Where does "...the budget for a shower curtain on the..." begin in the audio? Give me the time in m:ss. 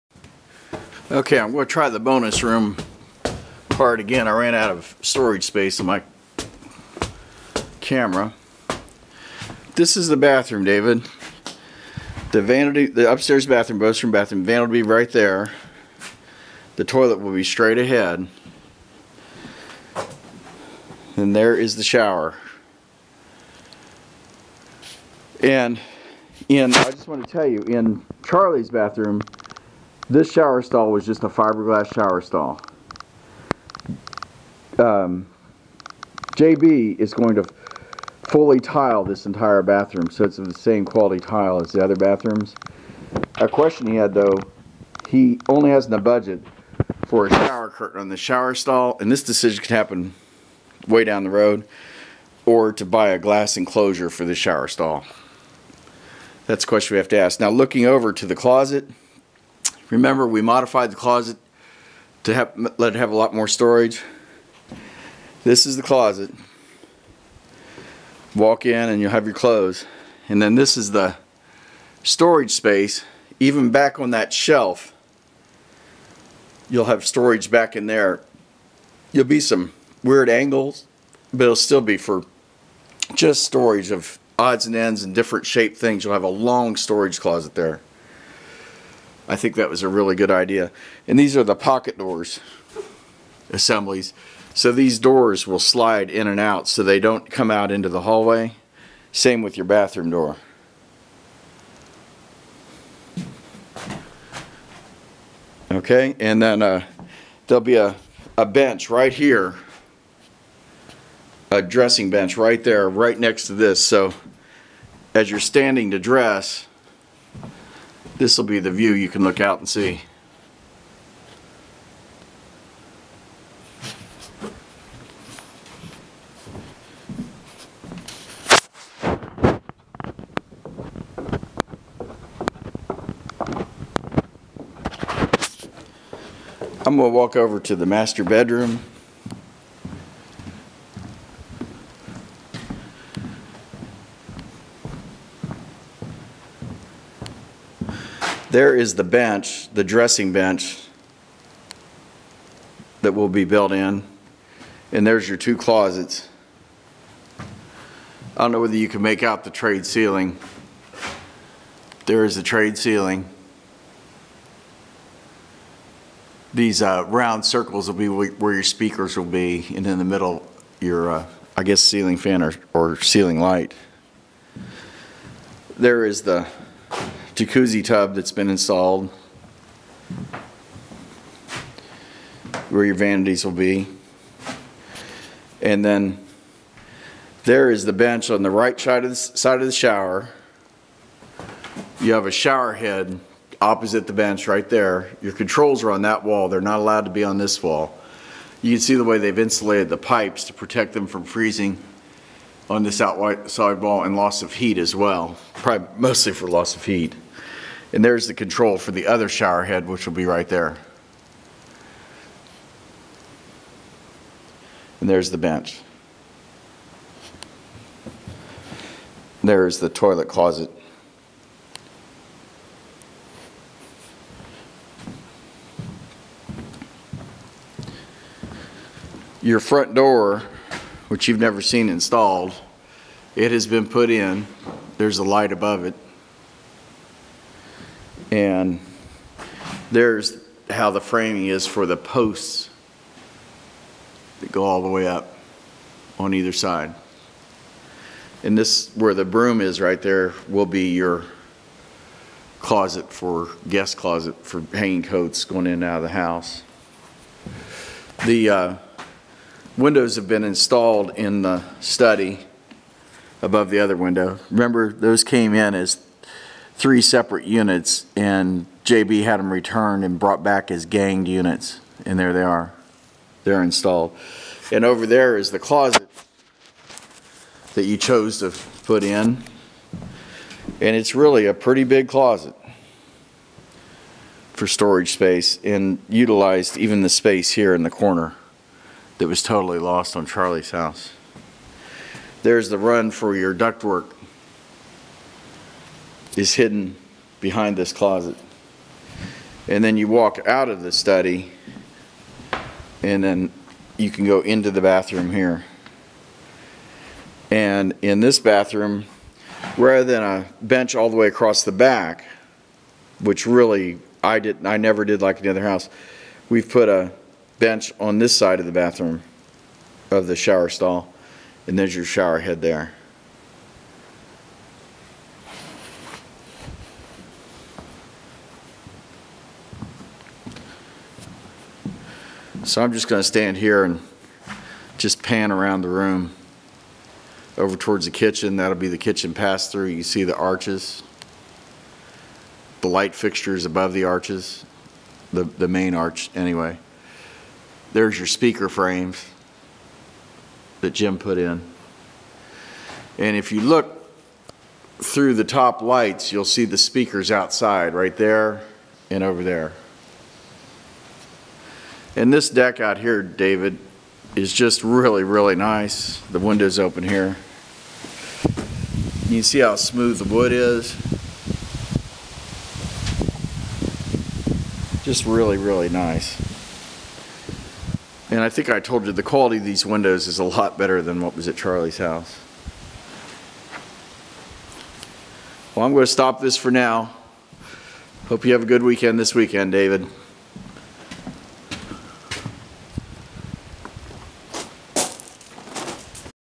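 0:45.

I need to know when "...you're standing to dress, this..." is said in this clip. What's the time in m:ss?
1:55.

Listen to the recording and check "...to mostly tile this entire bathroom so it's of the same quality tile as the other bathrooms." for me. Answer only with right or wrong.
wrong.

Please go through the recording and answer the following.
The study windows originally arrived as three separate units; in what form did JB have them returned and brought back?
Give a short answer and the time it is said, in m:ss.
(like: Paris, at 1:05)
ganged units, at 4:30.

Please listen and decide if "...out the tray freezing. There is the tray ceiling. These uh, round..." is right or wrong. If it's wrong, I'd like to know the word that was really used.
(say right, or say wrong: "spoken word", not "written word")
wrong: "ceiling", not "freezing".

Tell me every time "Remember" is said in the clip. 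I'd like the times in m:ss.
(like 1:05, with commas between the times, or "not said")
0:59, 4:24.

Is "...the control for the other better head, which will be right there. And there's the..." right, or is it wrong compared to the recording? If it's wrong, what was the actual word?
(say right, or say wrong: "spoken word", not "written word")
wrong: "shower", not "better".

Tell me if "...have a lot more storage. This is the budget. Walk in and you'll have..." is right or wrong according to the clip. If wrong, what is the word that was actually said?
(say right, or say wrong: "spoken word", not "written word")
wrong: "closet", not "budget".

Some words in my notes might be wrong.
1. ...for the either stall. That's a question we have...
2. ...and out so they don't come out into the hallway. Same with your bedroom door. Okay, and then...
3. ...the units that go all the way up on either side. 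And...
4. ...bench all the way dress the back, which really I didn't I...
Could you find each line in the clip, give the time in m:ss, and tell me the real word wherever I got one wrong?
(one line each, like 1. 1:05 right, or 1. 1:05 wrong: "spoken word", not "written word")
1. 0:54 wrong: "shower", not "either"
2. 1:36 wrong: "bathroom", not "bedroom"
3. 4:01 wrong: "posts", not "units"
4. 5:10 wrong: "across", not "dress".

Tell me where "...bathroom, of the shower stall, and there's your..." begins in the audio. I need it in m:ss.
5:18.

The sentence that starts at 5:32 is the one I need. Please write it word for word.
So I'm just going to stand here and just pan around the room.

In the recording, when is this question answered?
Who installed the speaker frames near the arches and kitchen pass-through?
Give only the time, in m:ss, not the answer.
5:50.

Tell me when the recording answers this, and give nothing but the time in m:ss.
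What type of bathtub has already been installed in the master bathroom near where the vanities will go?
2:57.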